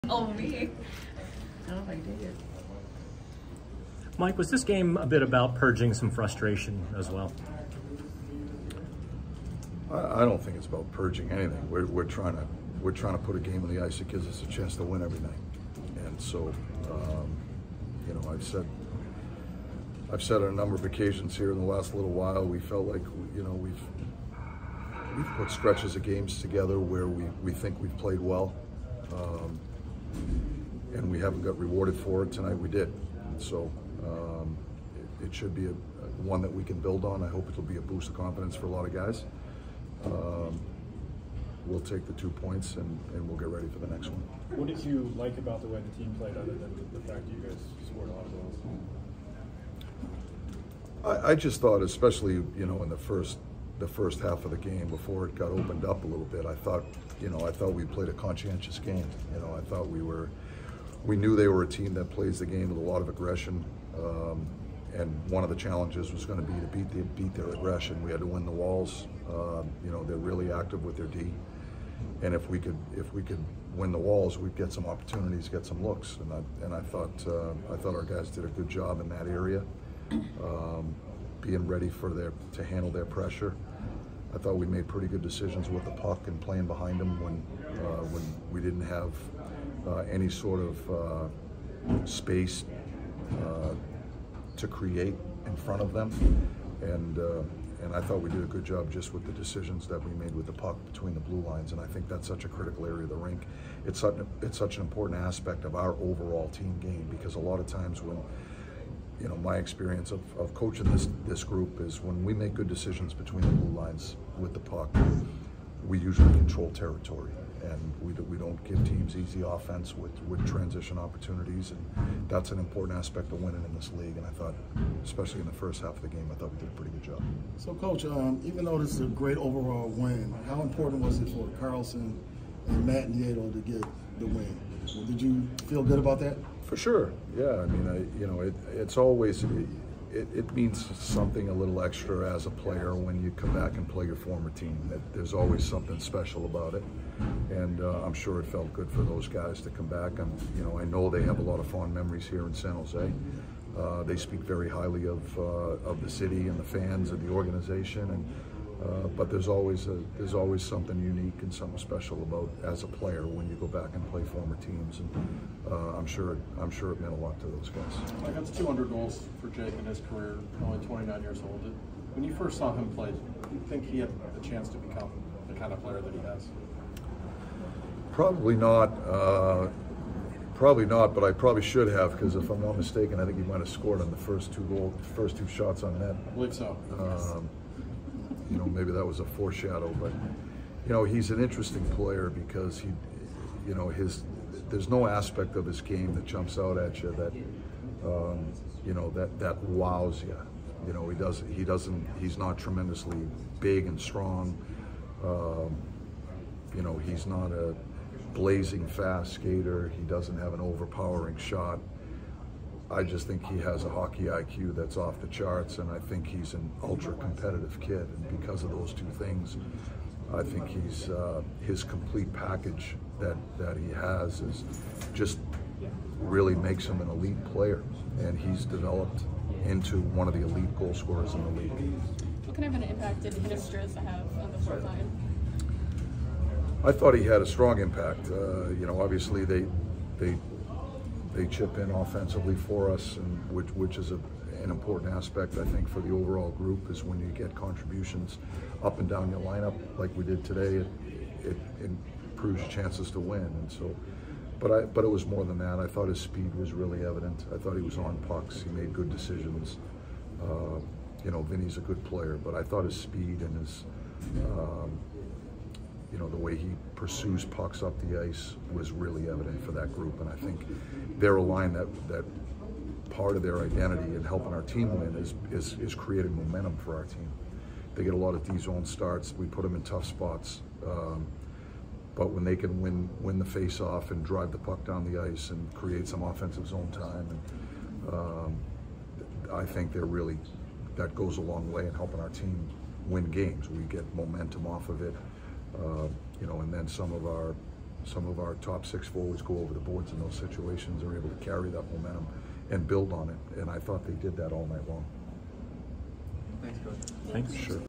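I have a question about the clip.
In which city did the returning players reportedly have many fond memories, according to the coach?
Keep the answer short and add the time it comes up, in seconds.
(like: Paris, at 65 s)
San Jose, at 152 s.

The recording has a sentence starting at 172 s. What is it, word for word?
When you first saw him play, did you think he had the chance to become the kind of player that he has?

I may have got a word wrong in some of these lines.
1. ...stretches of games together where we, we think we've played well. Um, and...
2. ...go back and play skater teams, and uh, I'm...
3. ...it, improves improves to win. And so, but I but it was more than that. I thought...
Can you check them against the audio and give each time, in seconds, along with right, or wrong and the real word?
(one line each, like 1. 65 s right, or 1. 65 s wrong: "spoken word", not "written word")
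1. 25 s right
2. 163 s wrong: "former", not "skater"
3. 251 s wrong: "chances", not "improves".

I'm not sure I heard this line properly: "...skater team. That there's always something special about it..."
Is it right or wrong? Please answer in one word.
wrong.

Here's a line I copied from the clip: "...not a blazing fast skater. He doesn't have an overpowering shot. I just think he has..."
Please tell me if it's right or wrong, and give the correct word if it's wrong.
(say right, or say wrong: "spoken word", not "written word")
right.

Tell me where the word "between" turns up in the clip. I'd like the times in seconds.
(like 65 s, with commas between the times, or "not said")
100 s, 113 s.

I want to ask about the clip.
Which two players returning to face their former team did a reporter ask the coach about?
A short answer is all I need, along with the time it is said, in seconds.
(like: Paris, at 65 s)
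Karlsson and Matt Nieto, at 131 s.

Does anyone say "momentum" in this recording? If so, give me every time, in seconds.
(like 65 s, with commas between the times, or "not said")
276 s, 294 s, 301 s.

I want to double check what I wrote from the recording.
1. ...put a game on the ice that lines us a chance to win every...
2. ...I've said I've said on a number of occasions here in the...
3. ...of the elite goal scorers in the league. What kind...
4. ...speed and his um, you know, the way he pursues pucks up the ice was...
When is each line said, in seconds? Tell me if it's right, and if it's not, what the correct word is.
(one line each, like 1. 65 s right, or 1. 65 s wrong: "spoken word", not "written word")
1. 13 s wrong: "gives", not "lines"
2. 18 s right
3. 230 s right
4. 262 s right.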